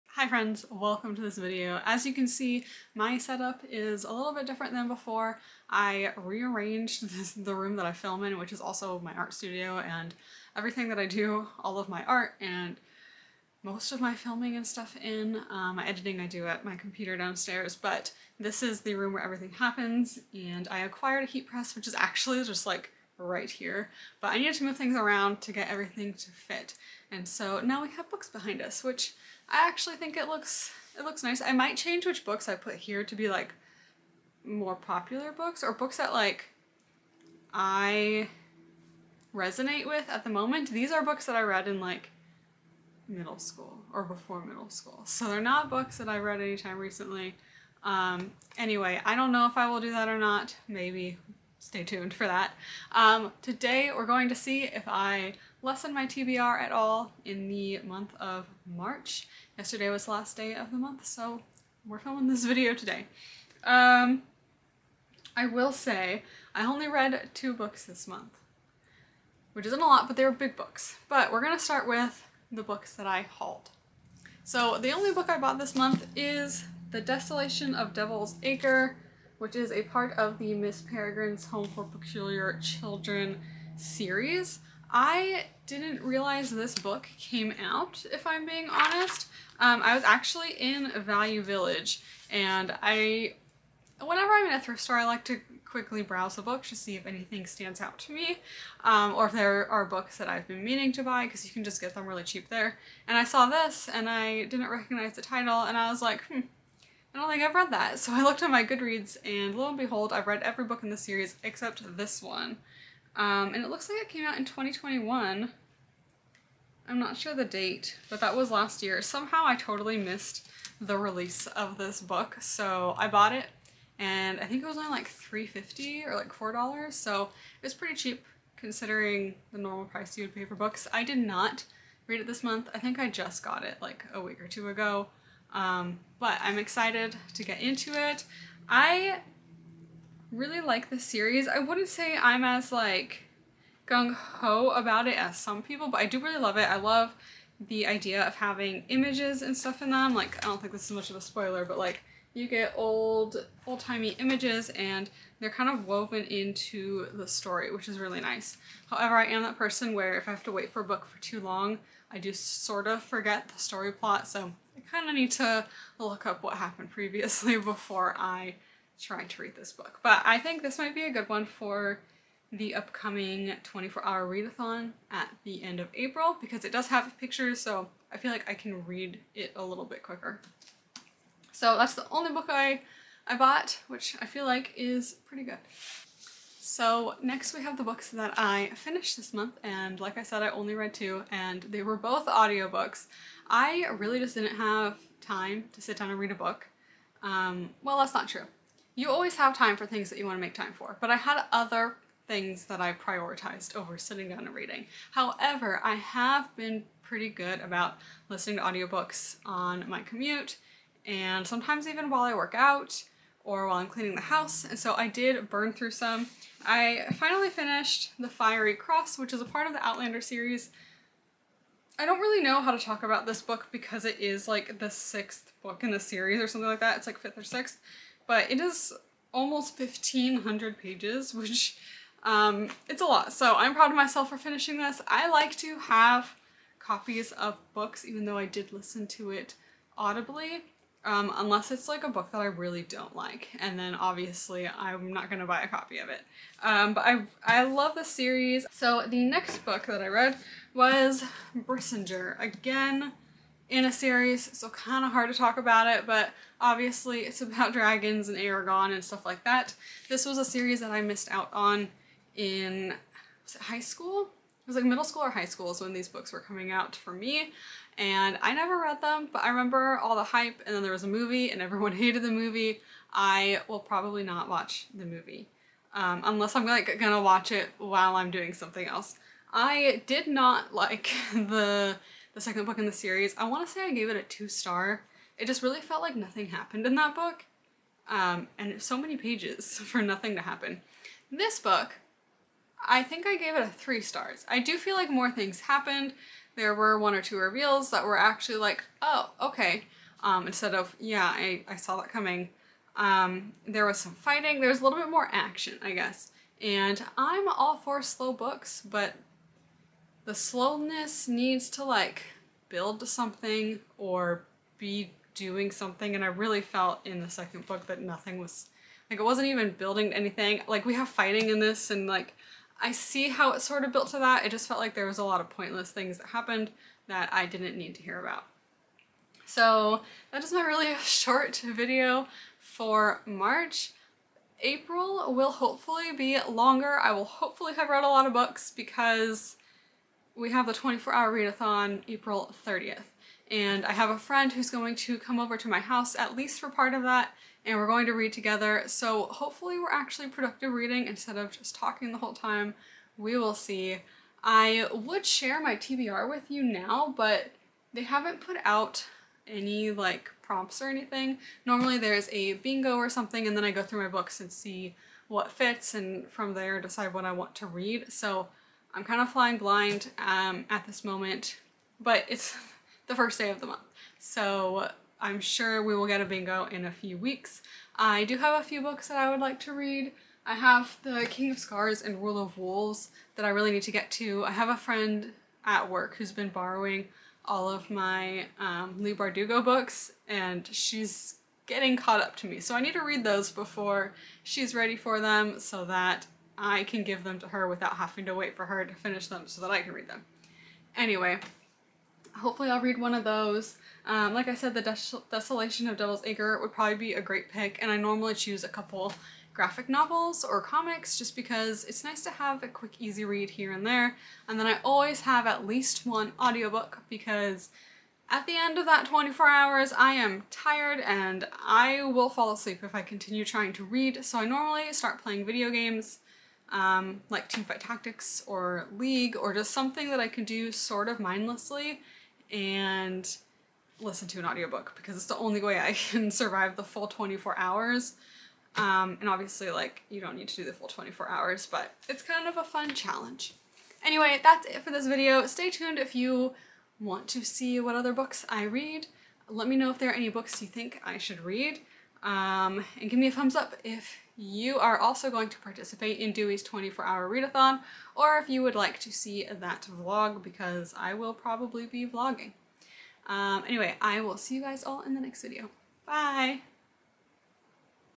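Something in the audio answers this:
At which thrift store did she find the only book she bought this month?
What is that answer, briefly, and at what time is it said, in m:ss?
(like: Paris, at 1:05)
Value Village, at 1:30.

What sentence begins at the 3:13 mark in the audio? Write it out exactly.
I really just didn't have time to sit down and read a book.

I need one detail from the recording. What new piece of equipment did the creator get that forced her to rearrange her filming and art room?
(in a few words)
Heat press.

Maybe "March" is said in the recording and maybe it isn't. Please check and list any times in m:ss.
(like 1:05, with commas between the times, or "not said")
0:58, 5:33.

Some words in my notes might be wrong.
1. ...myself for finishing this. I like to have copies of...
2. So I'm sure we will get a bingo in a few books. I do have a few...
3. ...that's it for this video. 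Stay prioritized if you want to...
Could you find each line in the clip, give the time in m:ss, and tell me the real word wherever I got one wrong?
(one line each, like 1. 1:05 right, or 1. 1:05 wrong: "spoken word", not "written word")
1. 3:53 right
2. 6:14 wrong: "weeks", not "books"
3. 7:24 wrong: "tuned", not "prioritized".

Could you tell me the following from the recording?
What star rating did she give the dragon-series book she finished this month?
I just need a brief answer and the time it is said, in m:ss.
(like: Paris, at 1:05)
3 stars, at 4:53.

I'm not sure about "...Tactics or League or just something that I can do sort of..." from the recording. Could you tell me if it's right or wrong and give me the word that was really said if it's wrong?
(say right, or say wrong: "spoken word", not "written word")
right.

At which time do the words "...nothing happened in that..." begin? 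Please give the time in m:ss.
4:46.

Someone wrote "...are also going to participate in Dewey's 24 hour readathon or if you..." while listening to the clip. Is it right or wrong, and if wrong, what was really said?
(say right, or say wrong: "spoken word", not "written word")
right.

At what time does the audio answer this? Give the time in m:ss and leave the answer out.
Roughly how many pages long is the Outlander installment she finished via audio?
3:49.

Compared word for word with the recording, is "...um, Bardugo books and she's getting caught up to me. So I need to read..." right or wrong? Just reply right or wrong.
right.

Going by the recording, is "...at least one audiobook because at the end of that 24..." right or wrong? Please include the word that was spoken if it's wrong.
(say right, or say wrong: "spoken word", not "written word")
right.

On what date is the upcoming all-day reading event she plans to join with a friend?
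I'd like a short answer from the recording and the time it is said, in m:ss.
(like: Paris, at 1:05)
April 30th, at 5:42.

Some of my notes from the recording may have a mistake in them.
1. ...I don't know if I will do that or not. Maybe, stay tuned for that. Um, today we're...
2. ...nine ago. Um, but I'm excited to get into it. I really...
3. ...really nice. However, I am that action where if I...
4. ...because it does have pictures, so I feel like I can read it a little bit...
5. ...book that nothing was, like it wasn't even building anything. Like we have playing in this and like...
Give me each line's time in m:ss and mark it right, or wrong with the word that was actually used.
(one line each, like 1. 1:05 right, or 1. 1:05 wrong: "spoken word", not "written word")
1. 0:49 right
2. 2:14 wrong: "two", not "nine"
3. 2:37 wrong: "person", not "action"
4. 2:56 right
5. 5:17 wrong: "fighting", not "playing".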